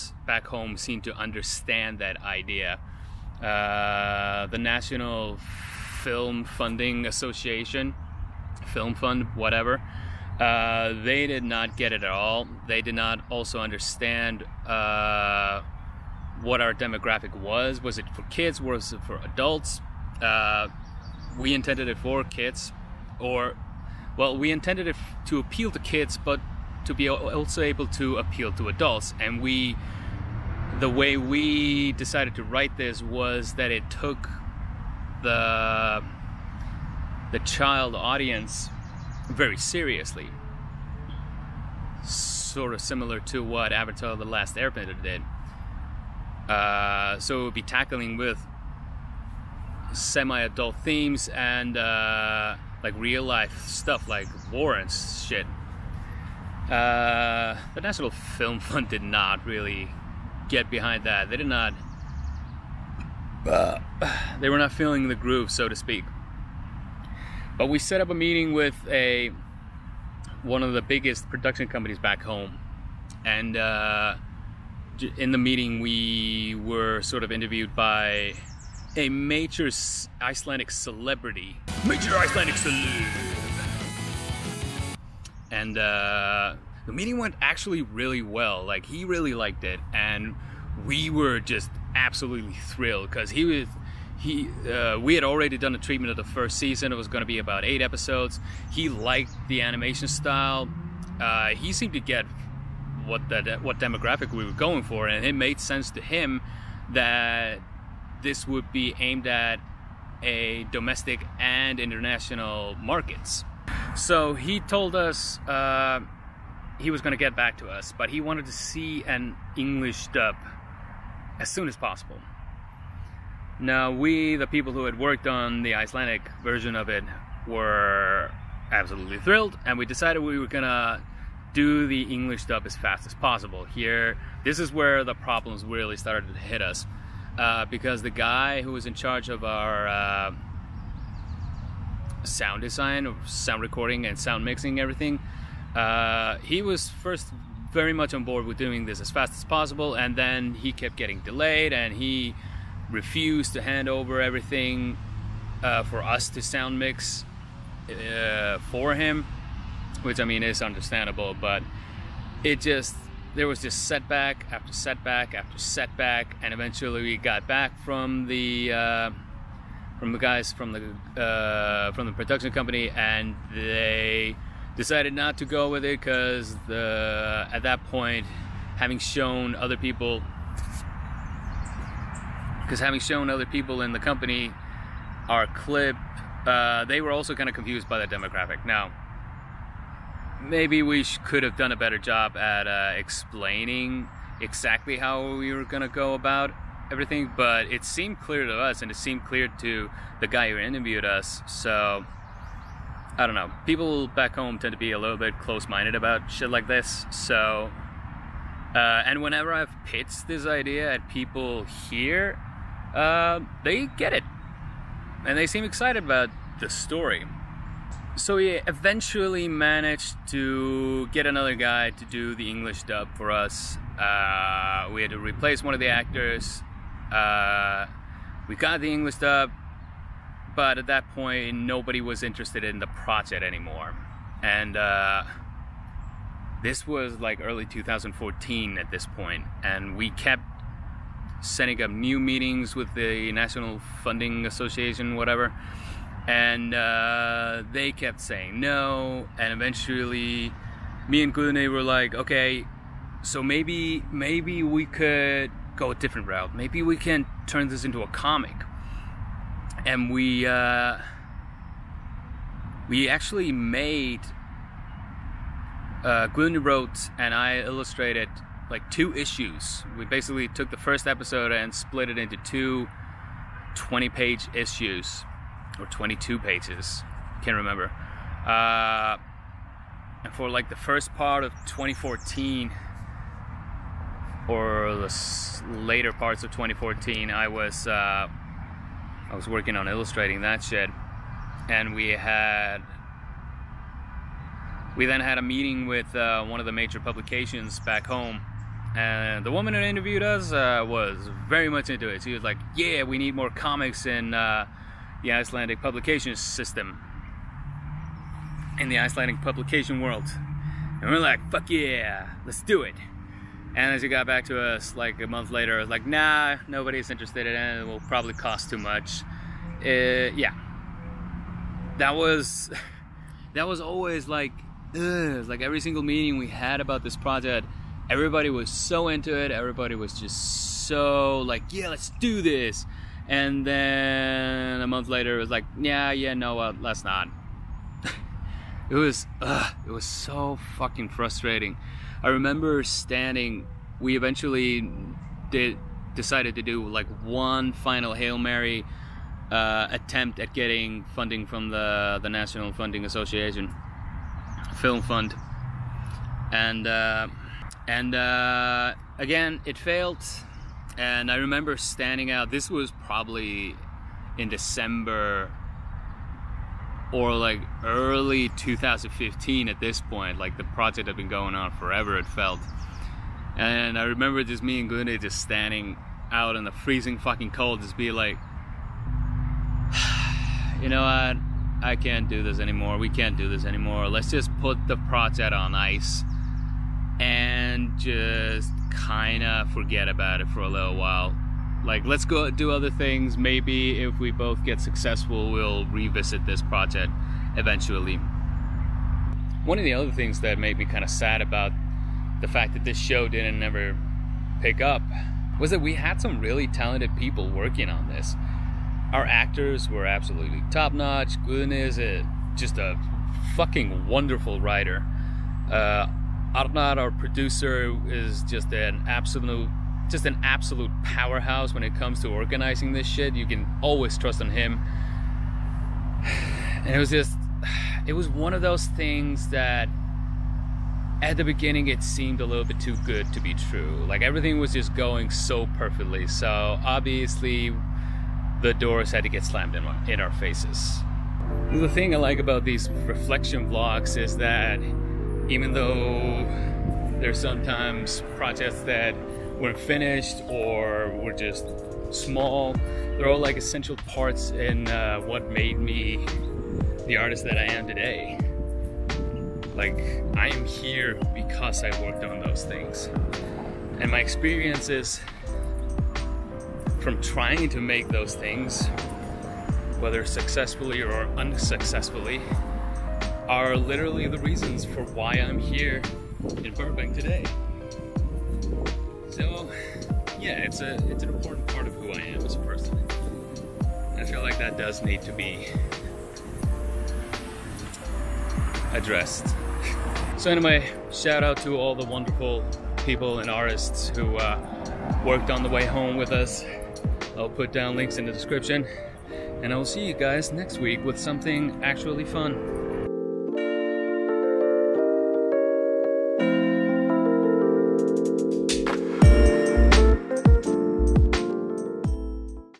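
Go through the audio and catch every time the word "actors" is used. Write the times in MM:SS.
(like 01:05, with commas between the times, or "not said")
03:45, 06:49.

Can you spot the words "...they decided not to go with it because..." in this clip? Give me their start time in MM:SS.
02:53.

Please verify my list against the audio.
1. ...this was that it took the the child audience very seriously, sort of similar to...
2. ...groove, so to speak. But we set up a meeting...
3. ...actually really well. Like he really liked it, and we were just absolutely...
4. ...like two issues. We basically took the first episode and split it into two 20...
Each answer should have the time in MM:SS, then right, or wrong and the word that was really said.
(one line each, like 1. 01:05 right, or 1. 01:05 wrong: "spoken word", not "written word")
1. 00:32 right
2. 01:05 right
3. 01:27 right
4. 04:28 right.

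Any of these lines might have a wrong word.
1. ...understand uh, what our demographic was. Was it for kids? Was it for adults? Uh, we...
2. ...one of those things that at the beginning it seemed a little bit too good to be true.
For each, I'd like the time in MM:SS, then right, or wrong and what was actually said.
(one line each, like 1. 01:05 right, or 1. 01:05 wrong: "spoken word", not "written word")
1. 00:13 right
2. 07:08 right.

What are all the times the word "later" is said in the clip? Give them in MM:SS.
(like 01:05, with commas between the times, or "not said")
04:45, 05:15, 05:35.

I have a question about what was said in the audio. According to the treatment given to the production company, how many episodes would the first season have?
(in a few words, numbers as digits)
8.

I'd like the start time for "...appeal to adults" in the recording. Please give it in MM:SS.
00:28.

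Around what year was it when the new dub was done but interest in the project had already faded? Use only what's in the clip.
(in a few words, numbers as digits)
2014.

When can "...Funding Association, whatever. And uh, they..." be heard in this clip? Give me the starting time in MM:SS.
04:04.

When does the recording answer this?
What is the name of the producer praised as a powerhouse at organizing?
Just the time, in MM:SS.
06:56.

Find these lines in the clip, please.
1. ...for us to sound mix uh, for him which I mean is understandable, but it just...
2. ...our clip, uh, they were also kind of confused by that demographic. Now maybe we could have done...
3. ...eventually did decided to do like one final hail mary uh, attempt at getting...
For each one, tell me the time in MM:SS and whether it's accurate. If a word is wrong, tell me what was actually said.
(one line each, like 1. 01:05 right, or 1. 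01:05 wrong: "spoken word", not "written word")
1. 02:35 right
2. 03:05 right
3. 05:44 right.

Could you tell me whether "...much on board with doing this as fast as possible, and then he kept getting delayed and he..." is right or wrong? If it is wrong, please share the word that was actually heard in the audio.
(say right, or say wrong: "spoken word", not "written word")
right.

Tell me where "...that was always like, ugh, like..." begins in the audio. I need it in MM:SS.
05:23.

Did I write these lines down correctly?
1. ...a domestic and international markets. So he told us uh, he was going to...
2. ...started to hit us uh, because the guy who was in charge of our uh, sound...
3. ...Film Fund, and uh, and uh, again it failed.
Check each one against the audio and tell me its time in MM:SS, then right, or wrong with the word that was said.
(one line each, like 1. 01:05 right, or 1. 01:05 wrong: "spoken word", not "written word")
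1. 01:50 right
2. 02:15 right
3. 05:54 right.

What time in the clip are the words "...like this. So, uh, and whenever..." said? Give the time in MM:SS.
03:26.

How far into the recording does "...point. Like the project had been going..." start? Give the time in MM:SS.
06:10.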